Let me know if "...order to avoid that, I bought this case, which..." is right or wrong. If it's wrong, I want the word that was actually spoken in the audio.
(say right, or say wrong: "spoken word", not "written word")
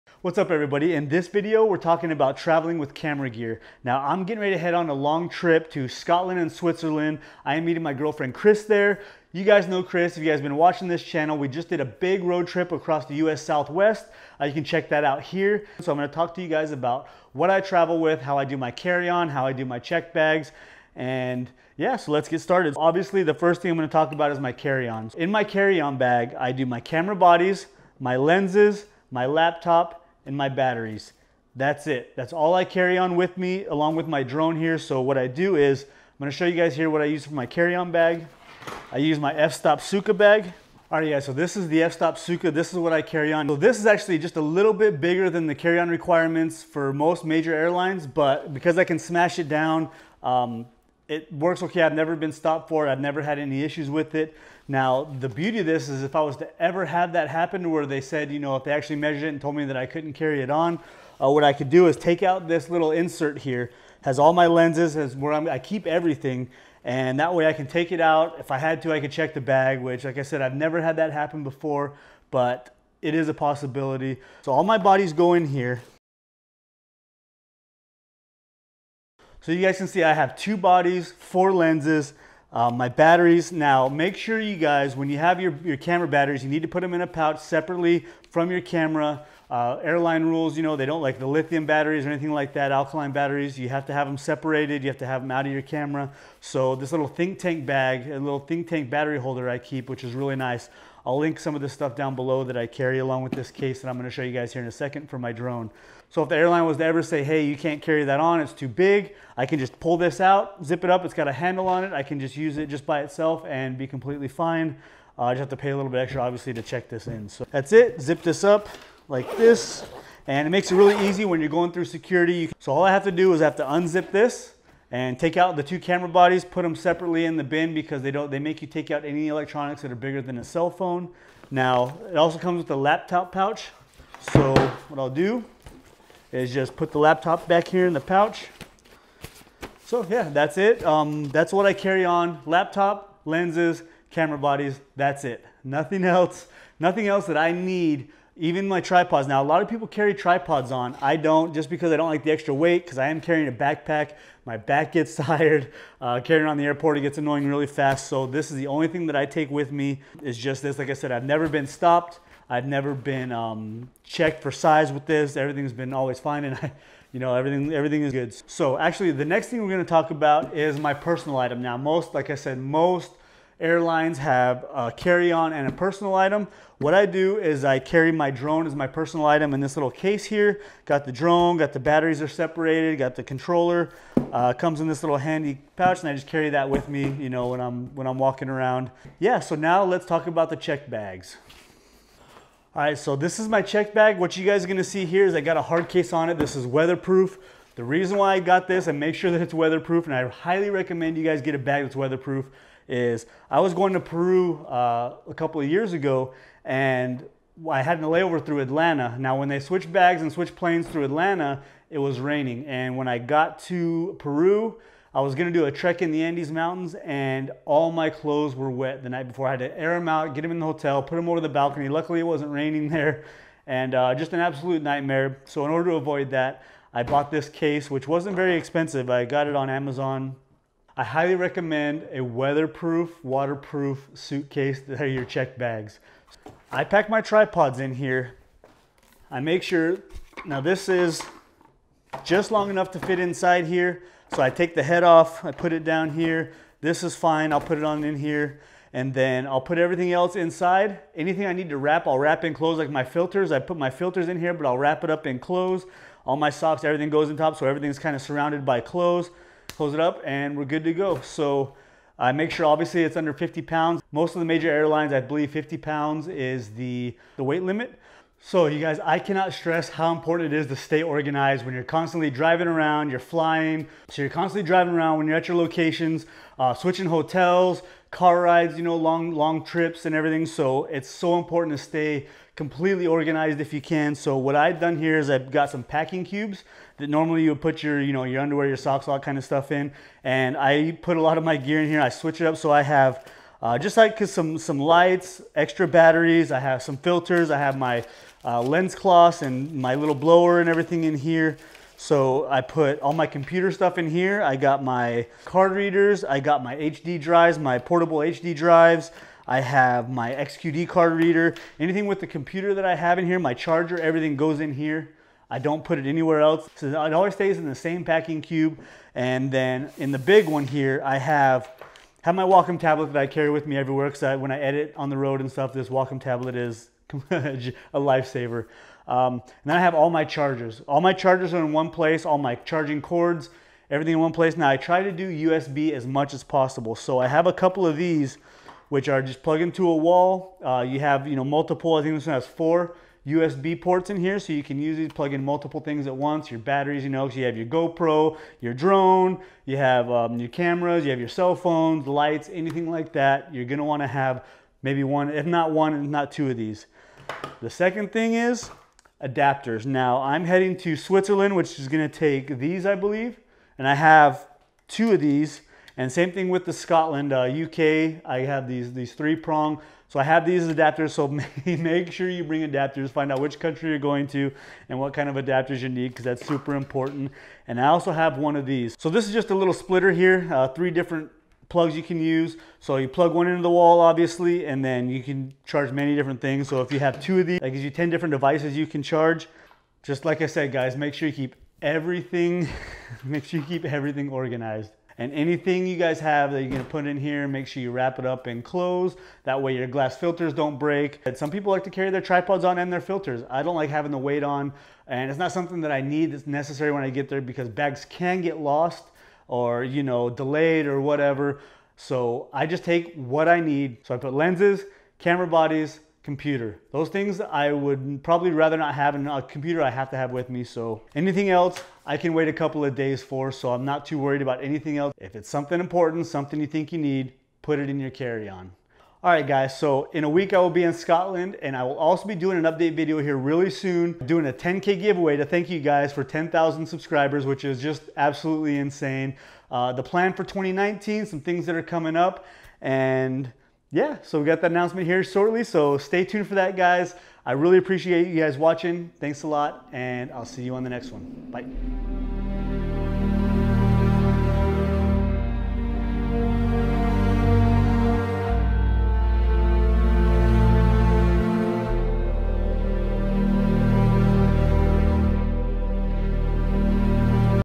right.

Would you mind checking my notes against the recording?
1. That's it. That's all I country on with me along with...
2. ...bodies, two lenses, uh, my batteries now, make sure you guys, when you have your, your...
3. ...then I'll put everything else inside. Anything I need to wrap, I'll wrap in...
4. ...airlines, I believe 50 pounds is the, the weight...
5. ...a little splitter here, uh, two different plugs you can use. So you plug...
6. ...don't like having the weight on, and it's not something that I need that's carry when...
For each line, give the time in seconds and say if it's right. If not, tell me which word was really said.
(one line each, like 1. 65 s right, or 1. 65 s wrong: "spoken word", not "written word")
1. 31 s wrong: "carry", not "country"
2. 80 s wrong: "four", not "two"
3. 249 s right
4. 264 s right
5. 379 s wrong: "three", not "two"
6. 403 s wrong: "necessary", not "carry".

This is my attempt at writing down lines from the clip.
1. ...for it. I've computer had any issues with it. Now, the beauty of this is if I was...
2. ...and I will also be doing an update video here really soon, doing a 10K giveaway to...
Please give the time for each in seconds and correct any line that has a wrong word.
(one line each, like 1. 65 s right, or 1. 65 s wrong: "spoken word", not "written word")
1. 52 s wrong: "never", not "computer"
2. 431 s right.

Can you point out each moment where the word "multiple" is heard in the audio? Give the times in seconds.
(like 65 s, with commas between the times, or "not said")
341 s, 345 s.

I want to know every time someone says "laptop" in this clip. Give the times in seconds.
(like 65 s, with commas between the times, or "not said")
29 s, 132 s, 136 s, 142 s.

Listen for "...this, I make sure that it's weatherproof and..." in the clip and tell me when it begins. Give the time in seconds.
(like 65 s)
198 s.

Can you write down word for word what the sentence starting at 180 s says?
Got the drone, got the batteries are separated, got the controller.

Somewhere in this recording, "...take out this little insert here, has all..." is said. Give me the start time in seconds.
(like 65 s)
61 s.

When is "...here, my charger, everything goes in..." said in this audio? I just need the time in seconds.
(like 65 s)
313 s.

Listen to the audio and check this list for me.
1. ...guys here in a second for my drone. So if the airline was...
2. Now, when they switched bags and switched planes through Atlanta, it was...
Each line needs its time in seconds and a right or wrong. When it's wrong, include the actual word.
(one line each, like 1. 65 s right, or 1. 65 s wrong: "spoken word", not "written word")
1. 104 s right
2. 209 s right.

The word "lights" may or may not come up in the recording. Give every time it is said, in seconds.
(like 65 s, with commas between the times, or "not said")
294 s, 352 s.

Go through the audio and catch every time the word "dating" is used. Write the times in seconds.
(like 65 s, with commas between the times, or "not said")
not said.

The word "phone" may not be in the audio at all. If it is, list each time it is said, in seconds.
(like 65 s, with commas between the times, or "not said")
130 s, 351 s.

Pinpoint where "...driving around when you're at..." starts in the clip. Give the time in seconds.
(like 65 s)
274 s.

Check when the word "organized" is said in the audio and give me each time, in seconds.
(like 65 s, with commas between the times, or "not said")
271 s, 283 s, 394 s.